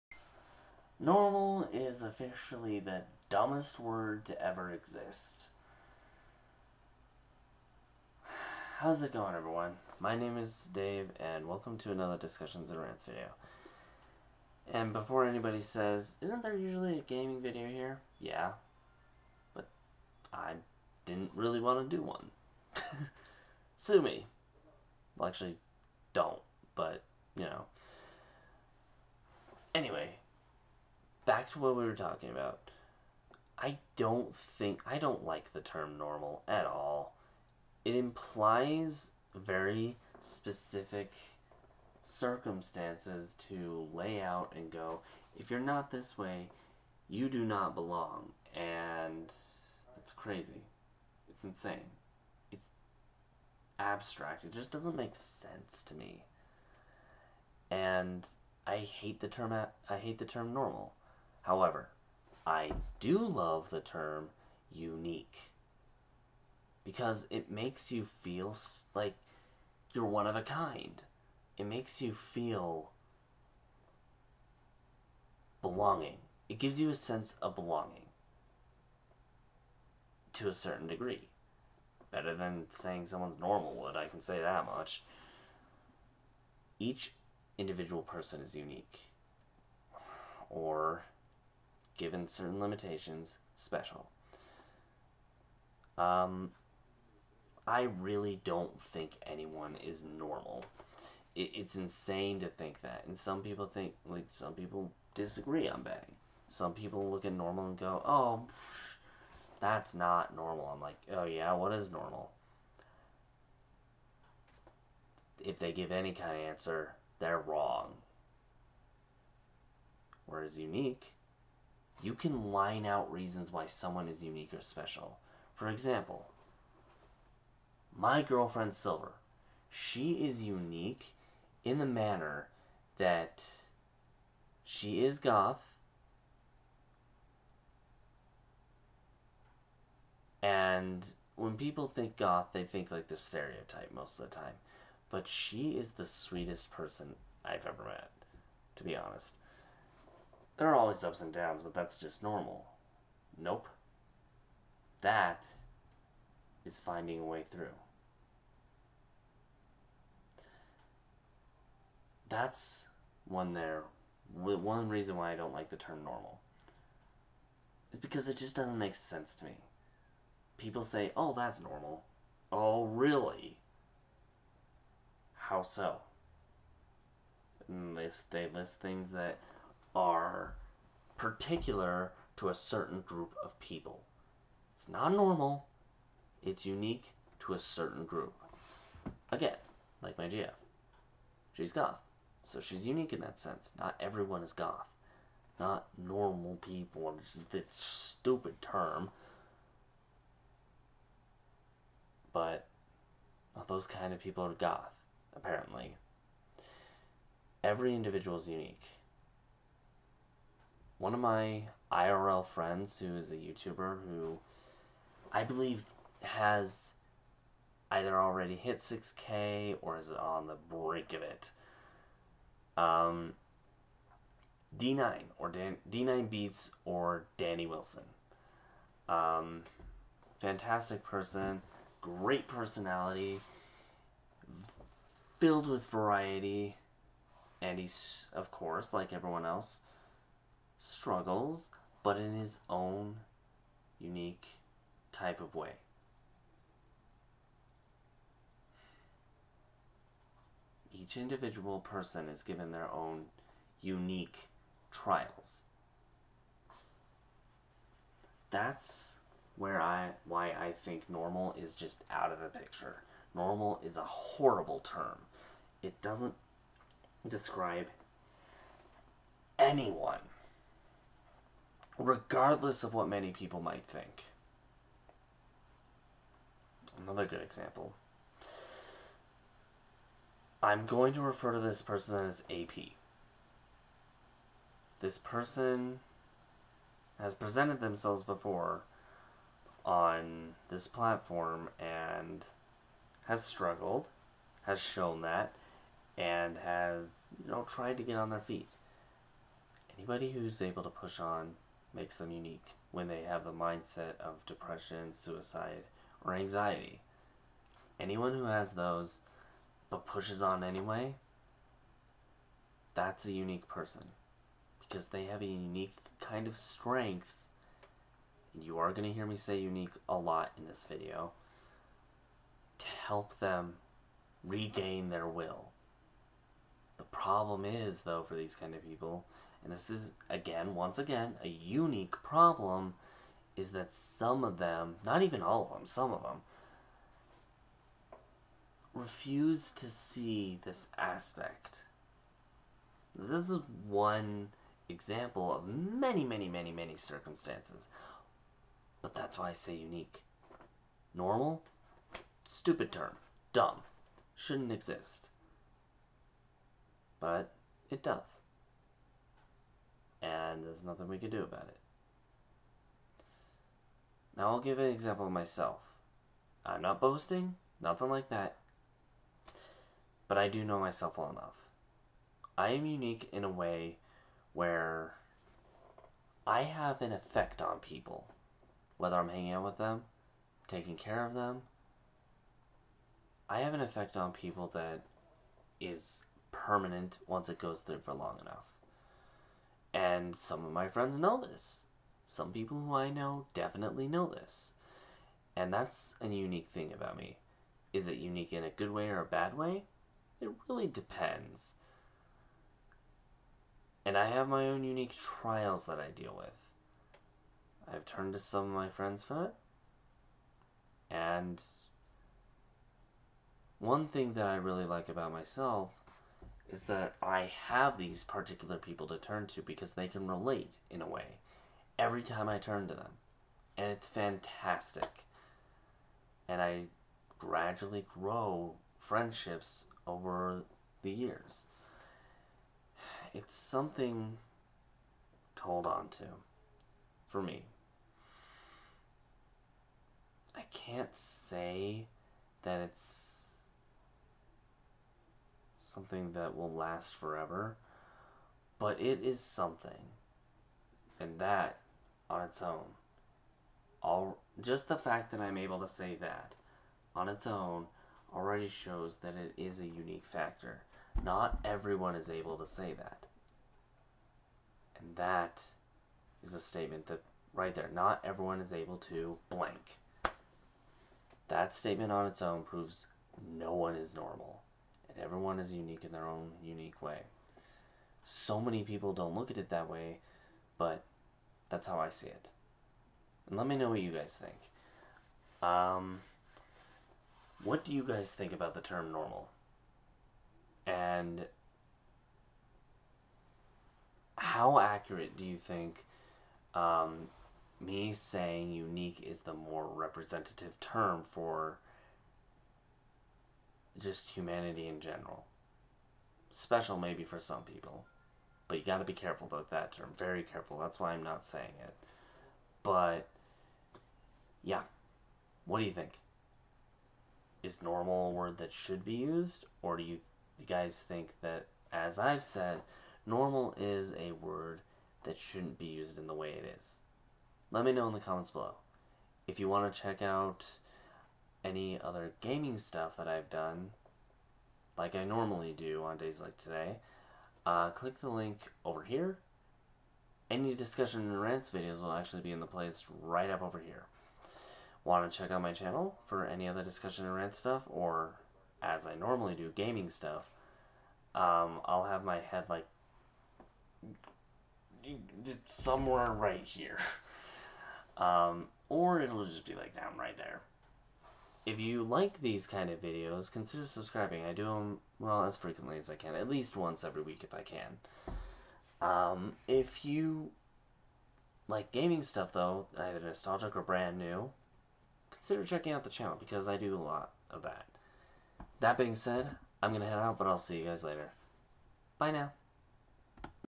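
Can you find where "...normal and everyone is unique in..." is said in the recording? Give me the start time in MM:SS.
07:54.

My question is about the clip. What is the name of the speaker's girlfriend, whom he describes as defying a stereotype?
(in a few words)
Silver.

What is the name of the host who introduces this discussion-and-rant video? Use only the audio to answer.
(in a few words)
Dave.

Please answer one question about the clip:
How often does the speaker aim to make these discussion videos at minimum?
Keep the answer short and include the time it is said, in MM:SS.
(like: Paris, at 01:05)
once every week, at 09:26.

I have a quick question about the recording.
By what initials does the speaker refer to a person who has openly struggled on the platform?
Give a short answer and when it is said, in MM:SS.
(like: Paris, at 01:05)
AP, at 04:42.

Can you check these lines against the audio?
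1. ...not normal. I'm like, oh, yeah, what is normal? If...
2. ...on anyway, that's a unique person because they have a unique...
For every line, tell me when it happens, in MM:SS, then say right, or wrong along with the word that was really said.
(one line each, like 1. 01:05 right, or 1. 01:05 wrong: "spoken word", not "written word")
1. 01:49 right
2. 05:10 right.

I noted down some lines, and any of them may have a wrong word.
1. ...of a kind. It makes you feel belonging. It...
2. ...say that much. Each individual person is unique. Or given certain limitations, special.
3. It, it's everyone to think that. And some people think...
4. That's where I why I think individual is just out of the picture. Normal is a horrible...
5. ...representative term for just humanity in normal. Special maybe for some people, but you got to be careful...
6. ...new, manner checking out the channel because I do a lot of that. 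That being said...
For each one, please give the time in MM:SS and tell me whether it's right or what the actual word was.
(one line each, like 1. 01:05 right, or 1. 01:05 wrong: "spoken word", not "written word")
1. 01:10 right
2. 01:24 right
3. 01:41 wrong: "insane", not "everyone"
4. 04:18 wrong: "normal", not "individual"
5. 08:19 wrong: "general", not "normal"
6. 09:34 wrong: "consider", not "manner".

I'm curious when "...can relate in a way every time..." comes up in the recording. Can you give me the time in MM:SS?
07:00.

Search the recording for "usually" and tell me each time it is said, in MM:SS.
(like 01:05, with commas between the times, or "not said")
00:16.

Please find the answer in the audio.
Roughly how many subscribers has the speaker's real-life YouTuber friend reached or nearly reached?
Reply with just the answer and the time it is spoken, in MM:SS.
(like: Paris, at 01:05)
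6K, at 03:38.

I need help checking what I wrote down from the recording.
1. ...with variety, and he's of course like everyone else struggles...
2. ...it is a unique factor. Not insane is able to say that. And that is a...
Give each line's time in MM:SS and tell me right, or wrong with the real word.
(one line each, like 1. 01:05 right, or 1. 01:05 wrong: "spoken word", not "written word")
1. 03:55 right
2. 07:39 wrong: "everyone", not "insane".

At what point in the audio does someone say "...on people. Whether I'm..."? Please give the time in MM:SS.
06:17.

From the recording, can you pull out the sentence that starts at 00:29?
Anyway, back to what we were talking about.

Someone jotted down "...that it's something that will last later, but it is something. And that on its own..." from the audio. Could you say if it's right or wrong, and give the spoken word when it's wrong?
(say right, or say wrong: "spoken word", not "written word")
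wrong: "forever", not "later".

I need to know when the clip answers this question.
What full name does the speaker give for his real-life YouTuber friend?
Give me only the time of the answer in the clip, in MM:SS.
03:47.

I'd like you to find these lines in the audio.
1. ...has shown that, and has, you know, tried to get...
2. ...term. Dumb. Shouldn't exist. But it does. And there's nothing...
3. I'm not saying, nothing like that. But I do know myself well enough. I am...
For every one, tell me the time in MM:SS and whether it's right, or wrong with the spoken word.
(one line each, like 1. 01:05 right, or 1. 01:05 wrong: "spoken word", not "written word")
1. 04:54 right
2. 05:52 right
3. 06:06 wrong: "boasting", not "saying".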